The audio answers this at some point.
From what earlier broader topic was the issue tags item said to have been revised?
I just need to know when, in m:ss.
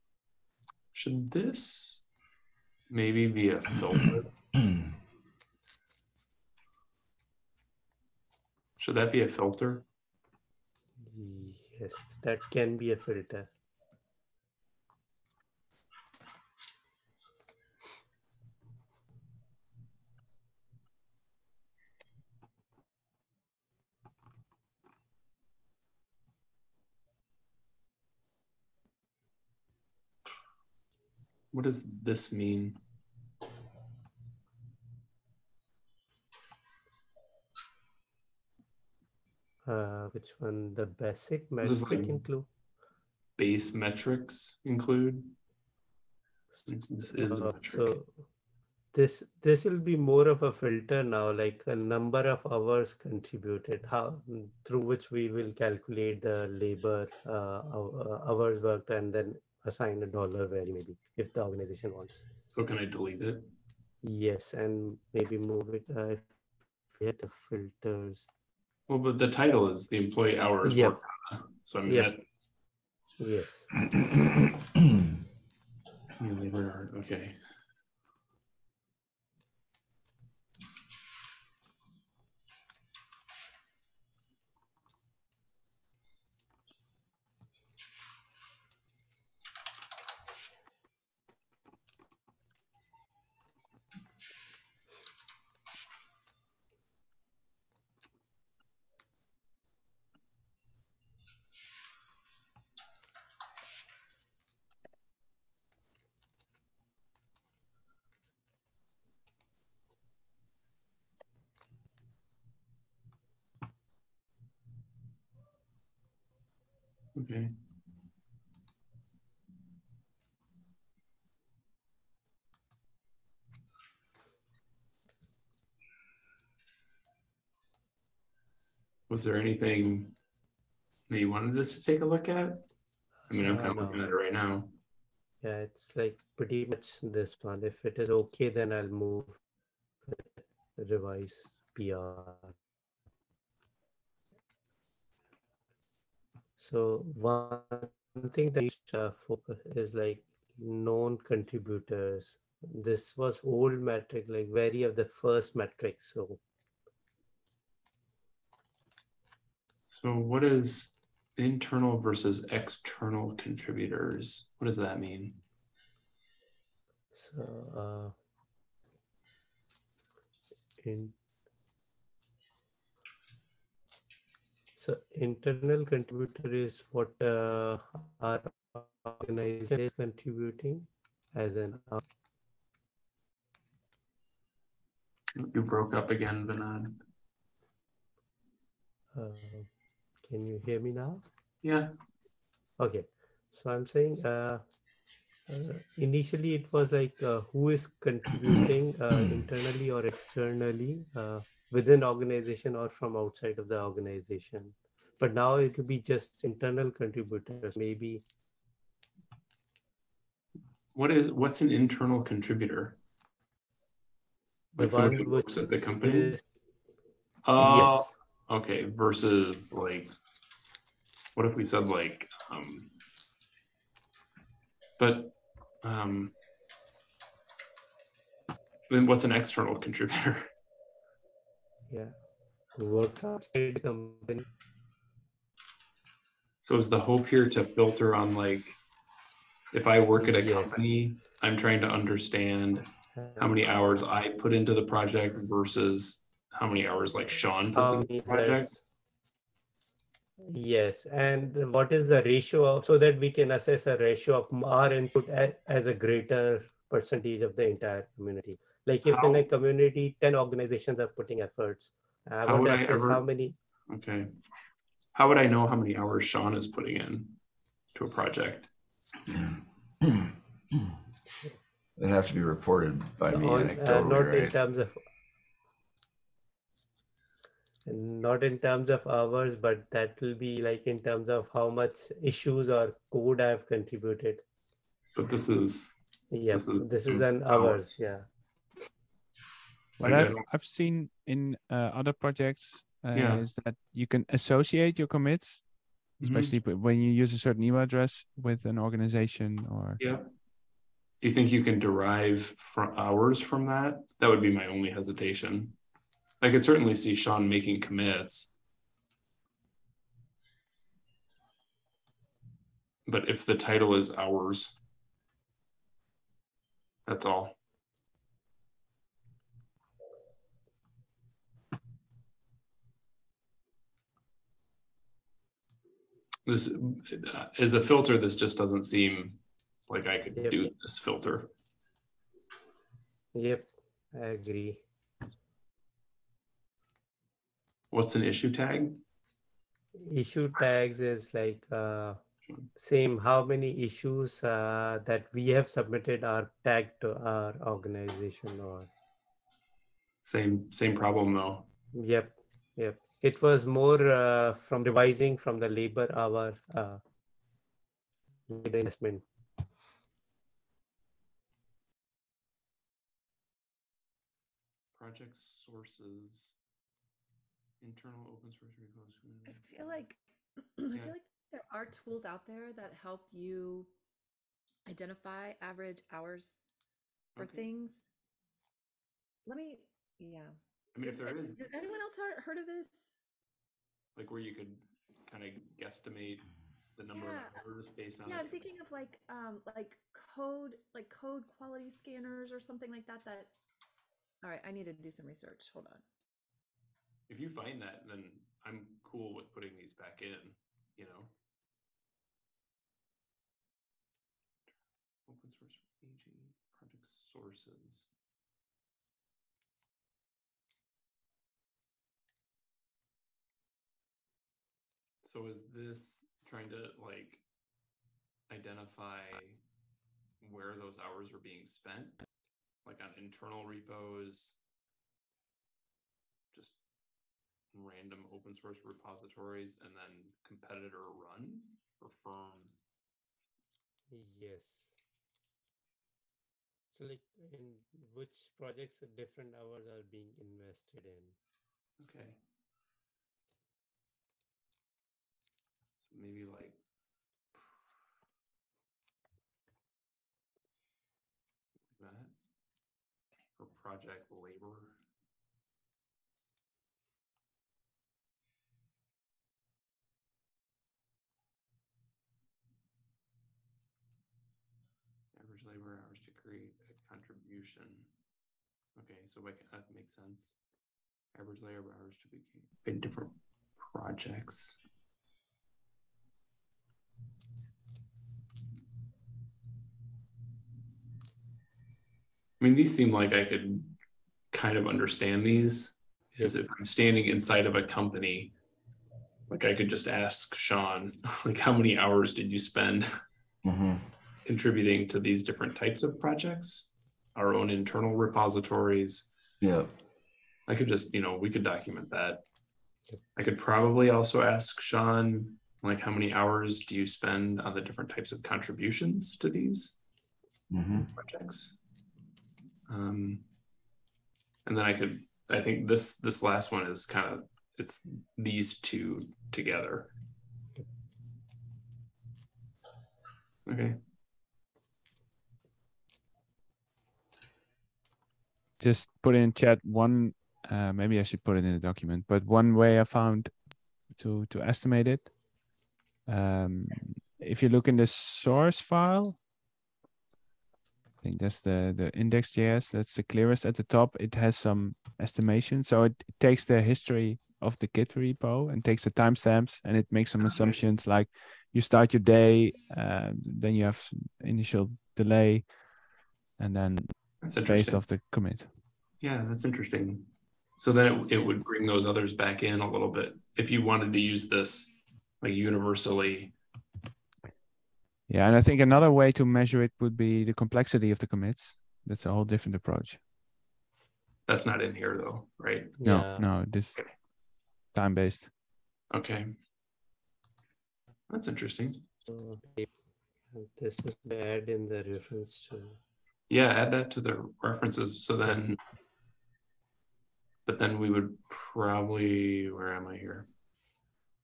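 5:58.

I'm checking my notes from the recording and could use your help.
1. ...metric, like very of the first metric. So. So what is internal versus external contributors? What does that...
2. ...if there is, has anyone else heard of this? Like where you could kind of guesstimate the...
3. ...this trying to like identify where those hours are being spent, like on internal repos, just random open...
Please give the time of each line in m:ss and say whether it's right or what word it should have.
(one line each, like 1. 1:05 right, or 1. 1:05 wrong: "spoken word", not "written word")
1. 2:33 right
2. 6:21 right
3. 6:55 right.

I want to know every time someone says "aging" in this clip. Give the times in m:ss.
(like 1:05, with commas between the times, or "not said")
6:46.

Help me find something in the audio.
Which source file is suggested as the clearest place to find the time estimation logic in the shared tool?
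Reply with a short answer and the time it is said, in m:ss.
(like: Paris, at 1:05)
index.js, at 9:02.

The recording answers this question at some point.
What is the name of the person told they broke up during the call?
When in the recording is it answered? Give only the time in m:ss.
3:06.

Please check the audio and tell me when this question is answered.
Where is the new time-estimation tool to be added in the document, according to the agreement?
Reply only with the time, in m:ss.
9:47.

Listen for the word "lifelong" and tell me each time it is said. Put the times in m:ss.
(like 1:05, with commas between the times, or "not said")
not said.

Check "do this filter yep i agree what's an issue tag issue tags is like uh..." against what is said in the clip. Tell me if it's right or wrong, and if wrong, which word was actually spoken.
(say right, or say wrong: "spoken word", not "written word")
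right.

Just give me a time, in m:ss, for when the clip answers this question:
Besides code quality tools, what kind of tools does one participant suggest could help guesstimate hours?
6:31.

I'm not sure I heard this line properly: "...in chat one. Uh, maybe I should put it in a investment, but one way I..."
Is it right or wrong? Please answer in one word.
wrong.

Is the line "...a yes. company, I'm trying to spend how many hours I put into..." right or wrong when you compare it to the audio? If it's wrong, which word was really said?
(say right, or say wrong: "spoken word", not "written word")
wrong: "understand", not "spend".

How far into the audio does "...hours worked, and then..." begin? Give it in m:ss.
0:58.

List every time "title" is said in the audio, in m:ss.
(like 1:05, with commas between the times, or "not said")
1:09, 5:13.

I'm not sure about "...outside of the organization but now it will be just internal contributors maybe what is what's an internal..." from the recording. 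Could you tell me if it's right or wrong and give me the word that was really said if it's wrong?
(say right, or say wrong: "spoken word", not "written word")
right.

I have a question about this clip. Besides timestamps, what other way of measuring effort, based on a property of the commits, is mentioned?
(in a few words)
complexity of the commits.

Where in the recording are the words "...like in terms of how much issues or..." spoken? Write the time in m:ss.
4:40.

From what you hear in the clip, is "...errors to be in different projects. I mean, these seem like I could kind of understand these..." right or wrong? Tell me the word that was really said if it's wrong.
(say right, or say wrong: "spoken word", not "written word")
wrong: "hours", not "errors".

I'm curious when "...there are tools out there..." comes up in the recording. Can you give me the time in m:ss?
6:11.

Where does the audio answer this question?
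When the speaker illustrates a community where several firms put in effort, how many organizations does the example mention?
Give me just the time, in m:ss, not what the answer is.
4:20.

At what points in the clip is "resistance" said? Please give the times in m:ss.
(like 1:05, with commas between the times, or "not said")
not said.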